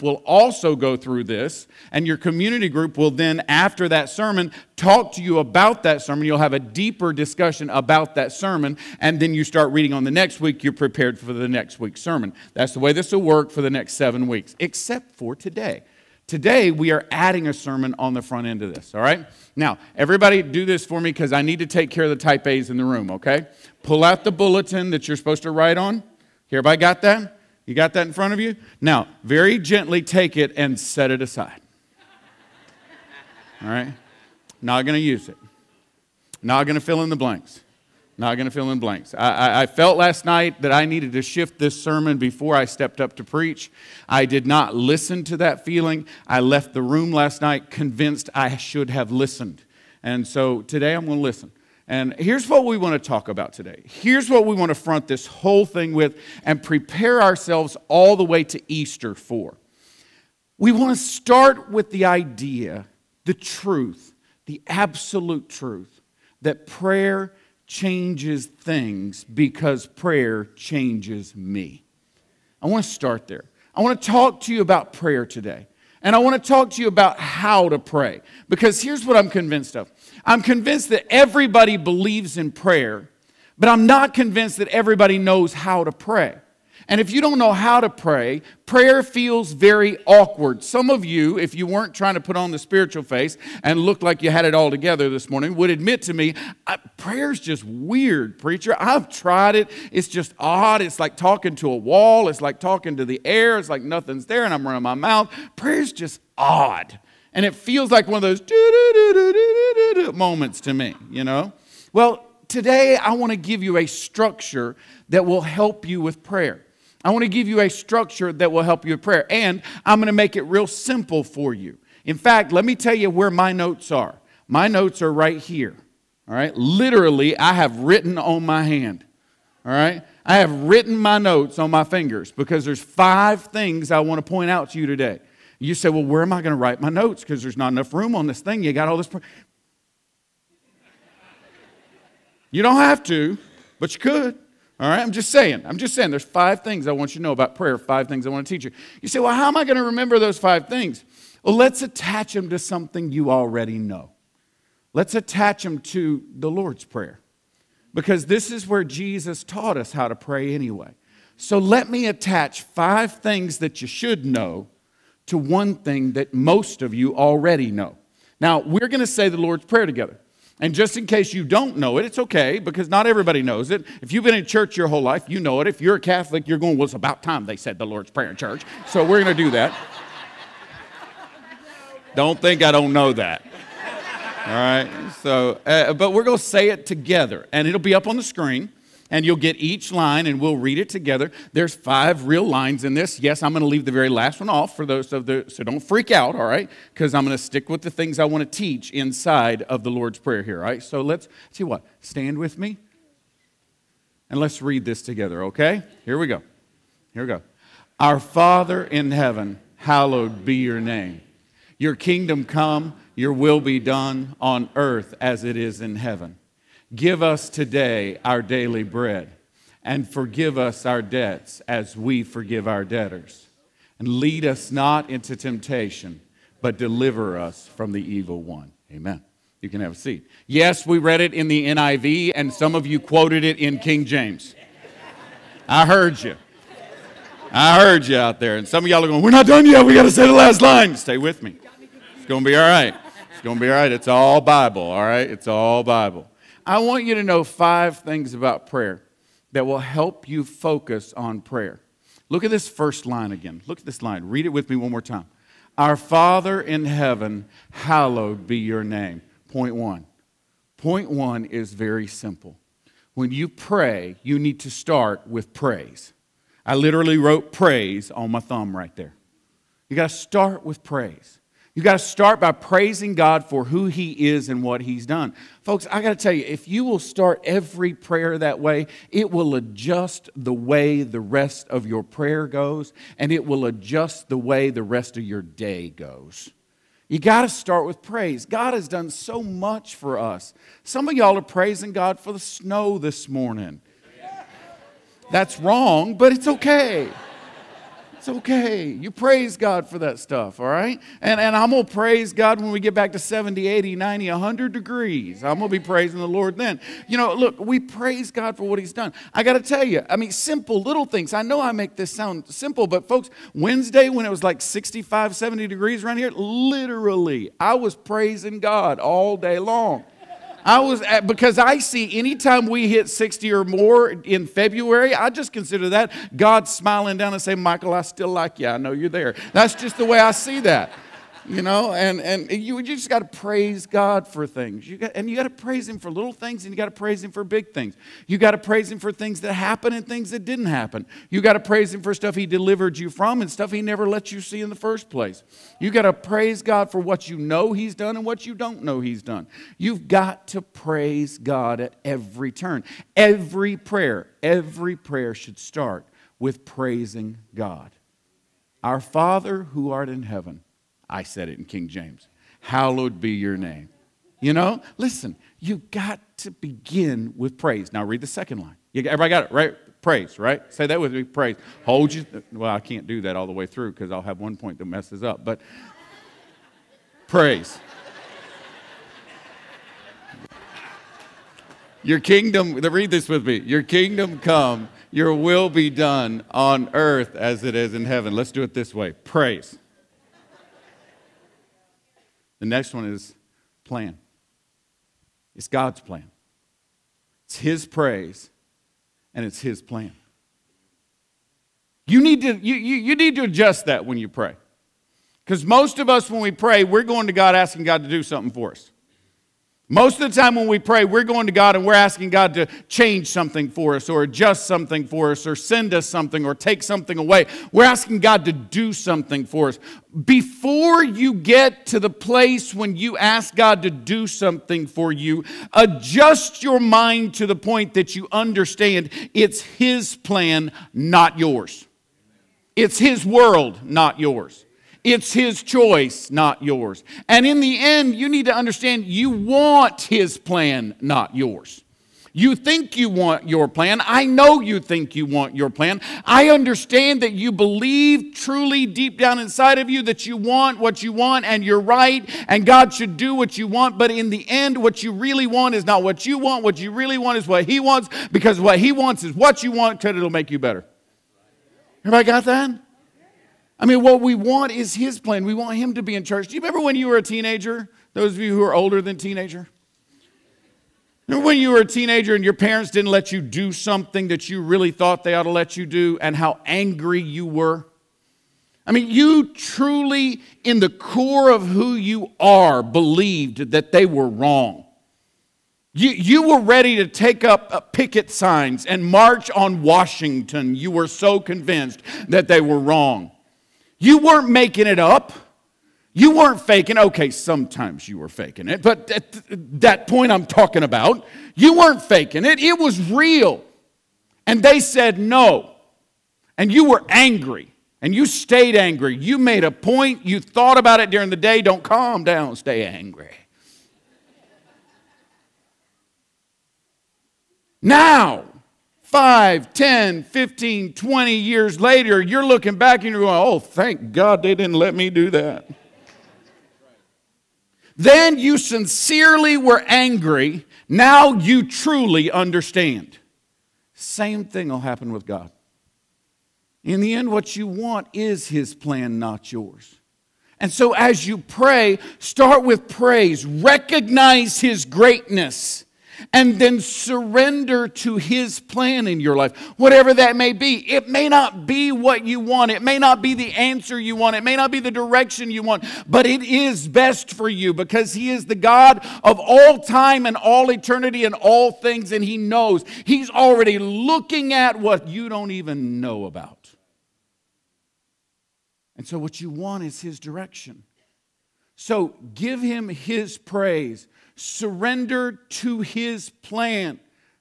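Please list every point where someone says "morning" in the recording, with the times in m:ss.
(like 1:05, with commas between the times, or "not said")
1:35, 4:53.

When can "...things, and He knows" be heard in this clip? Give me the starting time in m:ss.
9:21.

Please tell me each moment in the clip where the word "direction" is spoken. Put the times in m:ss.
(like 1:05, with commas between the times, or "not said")
9:14, 9:30.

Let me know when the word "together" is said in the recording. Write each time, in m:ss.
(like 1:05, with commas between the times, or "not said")
1:34, 2:49, 3:06, 3:10, 3:25.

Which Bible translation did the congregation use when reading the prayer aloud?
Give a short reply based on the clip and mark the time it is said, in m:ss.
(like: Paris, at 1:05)
NIV, at 3:51.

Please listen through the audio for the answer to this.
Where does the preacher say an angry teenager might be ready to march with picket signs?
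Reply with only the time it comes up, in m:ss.
8:09.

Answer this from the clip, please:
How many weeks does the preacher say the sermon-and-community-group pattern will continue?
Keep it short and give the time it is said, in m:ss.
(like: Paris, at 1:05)
7, at 0:13.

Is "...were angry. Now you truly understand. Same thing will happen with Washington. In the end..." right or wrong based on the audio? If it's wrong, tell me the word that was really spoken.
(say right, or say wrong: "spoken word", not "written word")
wrong: "God", not "Washington".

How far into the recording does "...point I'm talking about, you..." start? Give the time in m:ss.
8:20.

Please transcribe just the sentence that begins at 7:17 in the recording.
And in the end, you need to understand you want His plan, not yours.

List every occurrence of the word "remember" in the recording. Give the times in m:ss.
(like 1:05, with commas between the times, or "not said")
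2:29, 7:46, 7:51.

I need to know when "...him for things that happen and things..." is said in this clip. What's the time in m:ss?
5:38.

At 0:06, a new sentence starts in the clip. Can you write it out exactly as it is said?
You'll have a deeper discussion about that sermon, and then you start reading on the next week.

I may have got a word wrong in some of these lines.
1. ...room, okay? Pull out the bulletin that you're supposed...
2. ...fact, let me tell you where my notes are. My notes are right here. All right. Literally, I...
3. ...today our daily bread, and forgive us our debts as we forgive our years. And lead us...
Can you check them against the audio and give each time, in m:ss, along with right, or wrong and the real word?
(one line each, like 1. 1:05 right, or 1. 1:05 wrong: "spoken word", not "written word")
1. 0:22 right
2. 2:02 right
3. 3:37 wrong: "debtors", not "years".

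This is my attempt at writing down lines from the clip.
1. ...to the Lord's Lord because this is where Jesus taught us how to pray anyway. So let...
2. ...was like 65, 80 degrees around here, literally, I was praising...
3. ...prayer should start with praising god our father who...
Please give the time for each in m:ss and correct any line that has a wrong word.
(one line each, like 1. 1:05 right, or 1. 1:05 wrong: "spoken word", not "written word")
1. 2:35 wrong: "Prayer", not "Lord"
2. 5:14 wrong: "70", not "80"
3. 5:54 right.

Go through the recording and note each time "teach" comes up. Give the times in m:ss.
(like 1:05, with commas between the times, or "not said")
2:28, 3:18.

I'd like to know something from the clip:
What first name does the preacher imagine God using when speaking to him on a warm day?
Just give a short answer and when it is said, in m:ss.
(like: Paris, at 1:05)
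Michael, at 5:27.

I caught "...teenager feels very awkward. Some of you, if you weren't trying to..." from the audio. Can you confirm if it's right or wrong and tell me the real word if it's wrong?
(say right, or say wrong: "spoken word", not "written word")
wrong: "prayer", not "teenager".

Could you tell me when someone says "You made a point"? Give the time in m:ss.
8:29.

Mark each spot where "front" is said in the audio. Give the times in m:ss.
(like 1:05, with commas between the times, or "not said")
0:18, 0:28, 0:54.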